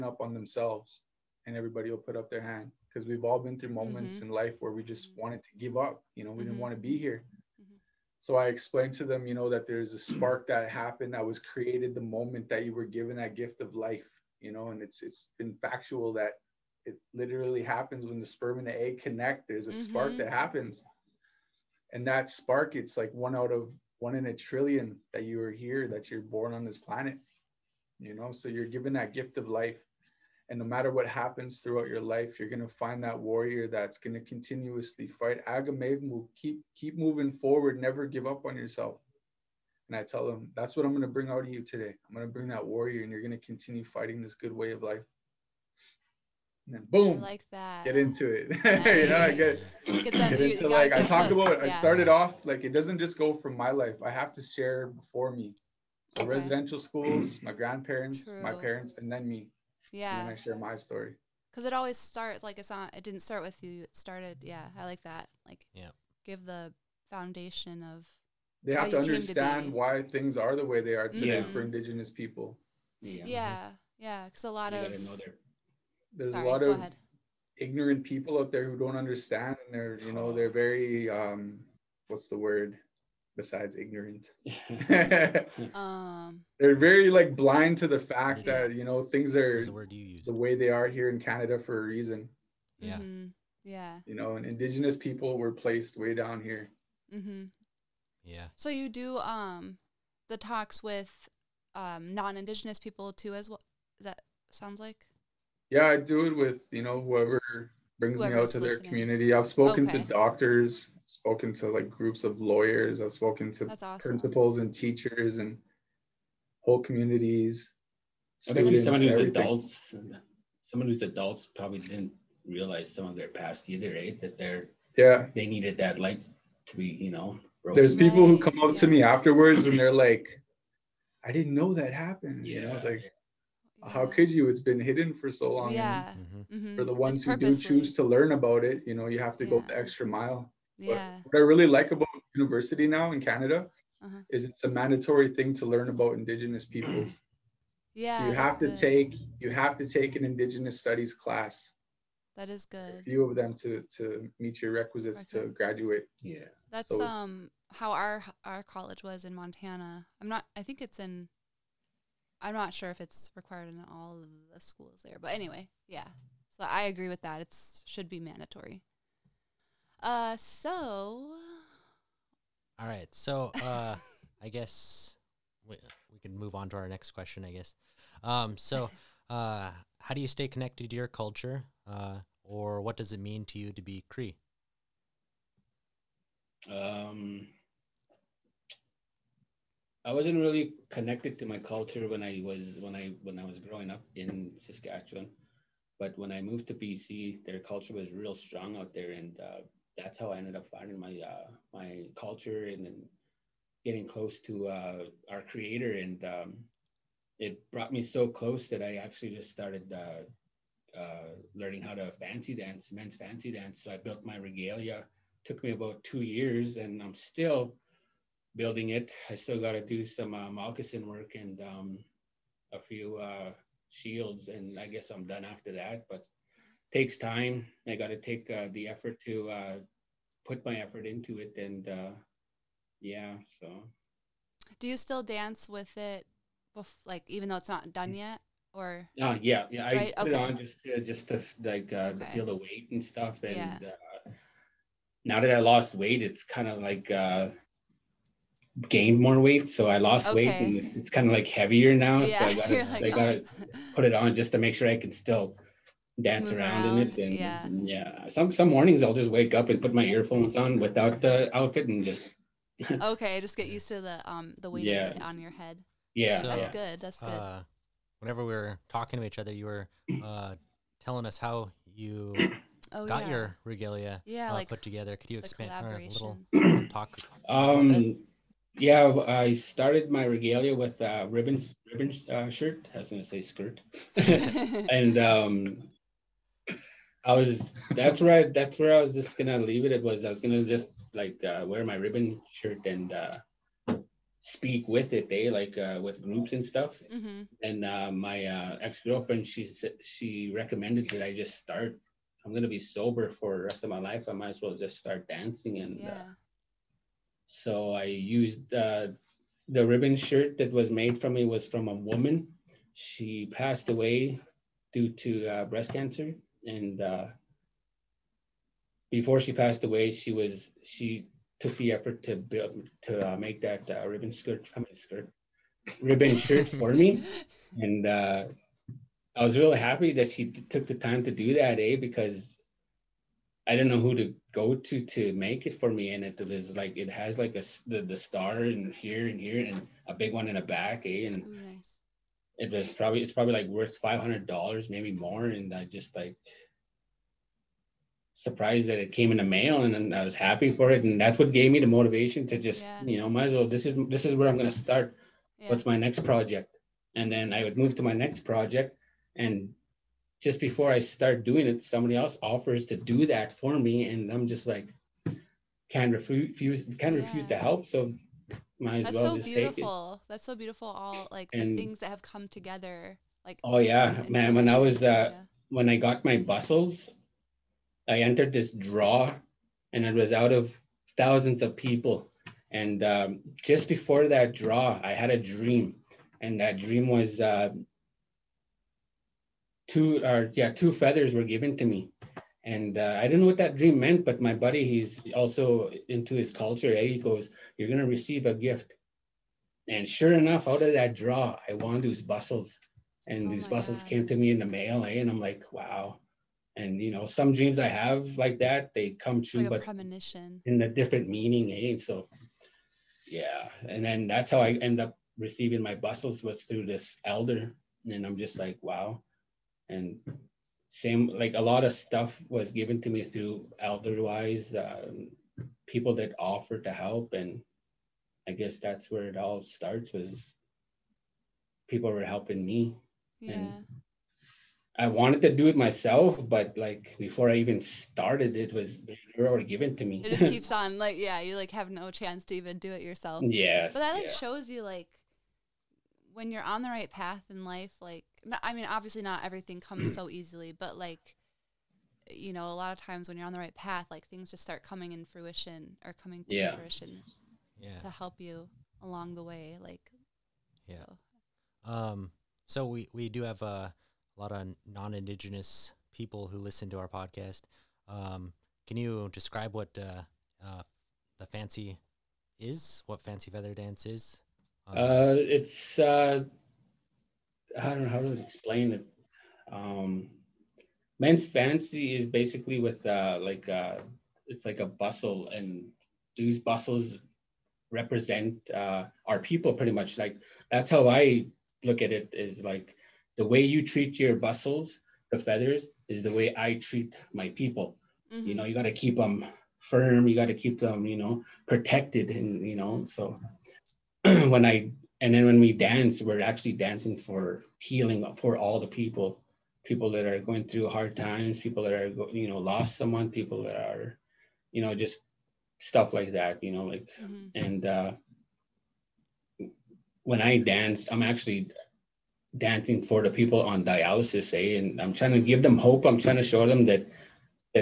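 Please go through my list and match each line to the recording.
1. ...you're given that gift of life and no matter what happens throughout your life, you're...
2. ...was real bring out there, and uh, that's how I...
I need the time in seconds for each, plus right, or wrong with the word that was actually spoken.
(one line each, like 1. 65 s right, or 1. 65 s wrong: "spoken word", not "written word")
1. 28 s right
2. 197 s wrong: "strong", not "bring".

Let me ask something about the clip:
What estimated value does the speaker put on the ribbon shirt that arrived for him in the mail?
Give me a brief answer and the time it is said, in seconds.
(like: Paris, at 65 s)
$500, at 343 s.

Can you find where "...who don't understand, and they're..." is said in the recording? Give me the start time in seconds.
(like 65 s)
78 s.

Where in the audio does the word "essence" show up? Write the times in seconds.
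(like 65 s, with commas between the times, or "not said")
not said.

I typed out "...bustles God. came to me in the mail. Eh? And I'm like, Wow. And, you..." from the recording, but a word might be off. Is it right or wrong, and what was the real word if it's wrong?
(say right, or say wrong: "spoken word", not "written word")
right.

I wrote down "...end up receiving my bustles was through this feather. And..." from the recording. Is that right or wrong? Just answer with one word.
wrong.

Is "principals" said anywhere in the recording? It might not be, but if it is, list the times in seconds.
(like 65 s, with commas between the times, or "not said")
113 s.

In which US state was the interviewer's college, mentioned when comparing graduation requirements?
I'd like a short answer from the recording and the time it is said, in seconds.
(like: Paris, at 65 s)
Montana, at 159 s.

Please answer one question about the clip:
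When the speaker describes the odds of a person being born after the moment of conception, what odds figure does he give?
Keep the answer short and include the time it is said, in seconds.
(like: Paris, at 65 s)
One in a trillion, at 23 s.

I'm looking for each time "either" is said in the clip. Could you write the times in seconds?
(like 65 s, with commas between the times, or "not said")
123 s.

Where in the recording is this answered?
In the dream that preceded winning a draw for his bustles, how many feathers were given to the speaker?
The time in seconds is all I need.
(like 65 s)
390 s.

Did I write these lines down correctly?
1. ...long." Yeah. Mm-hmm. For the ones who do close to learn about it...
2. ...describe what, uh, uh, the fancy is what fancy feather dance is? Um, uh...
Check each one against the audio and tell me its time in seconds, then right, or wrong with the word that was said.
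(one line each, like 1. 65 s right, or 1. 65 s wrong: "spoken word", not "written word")
1. 135 s wrong: "choose", not "close"
2. 469 s right.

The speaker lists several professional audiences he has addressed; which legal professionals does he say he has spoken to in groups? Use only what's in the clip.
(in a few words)
Lawyers.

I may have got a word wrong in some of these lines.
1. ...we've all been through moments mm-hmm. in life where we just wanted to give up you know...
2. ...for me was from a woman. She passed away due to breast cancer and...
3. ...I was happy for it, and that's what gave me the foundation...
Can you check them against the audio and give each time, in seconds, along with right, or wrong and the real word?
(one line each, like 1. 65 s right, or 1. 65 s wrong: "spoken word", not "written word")
1. 3 s right
2. 311 s right
3. 350 s wrong: "motivation", not "foundation".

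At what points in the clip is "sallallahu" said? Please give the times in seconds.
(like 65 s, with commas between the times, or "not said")
not said.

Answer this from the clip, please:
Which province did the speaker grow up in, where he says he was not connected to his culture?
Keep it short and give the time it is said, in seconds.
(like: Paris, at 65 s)
Saskatchewan, at 194 s.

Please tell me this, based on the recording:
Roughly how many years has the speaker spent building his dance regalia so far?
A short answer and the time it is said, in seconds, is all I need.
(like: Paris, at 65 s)
2 years, at 216 s.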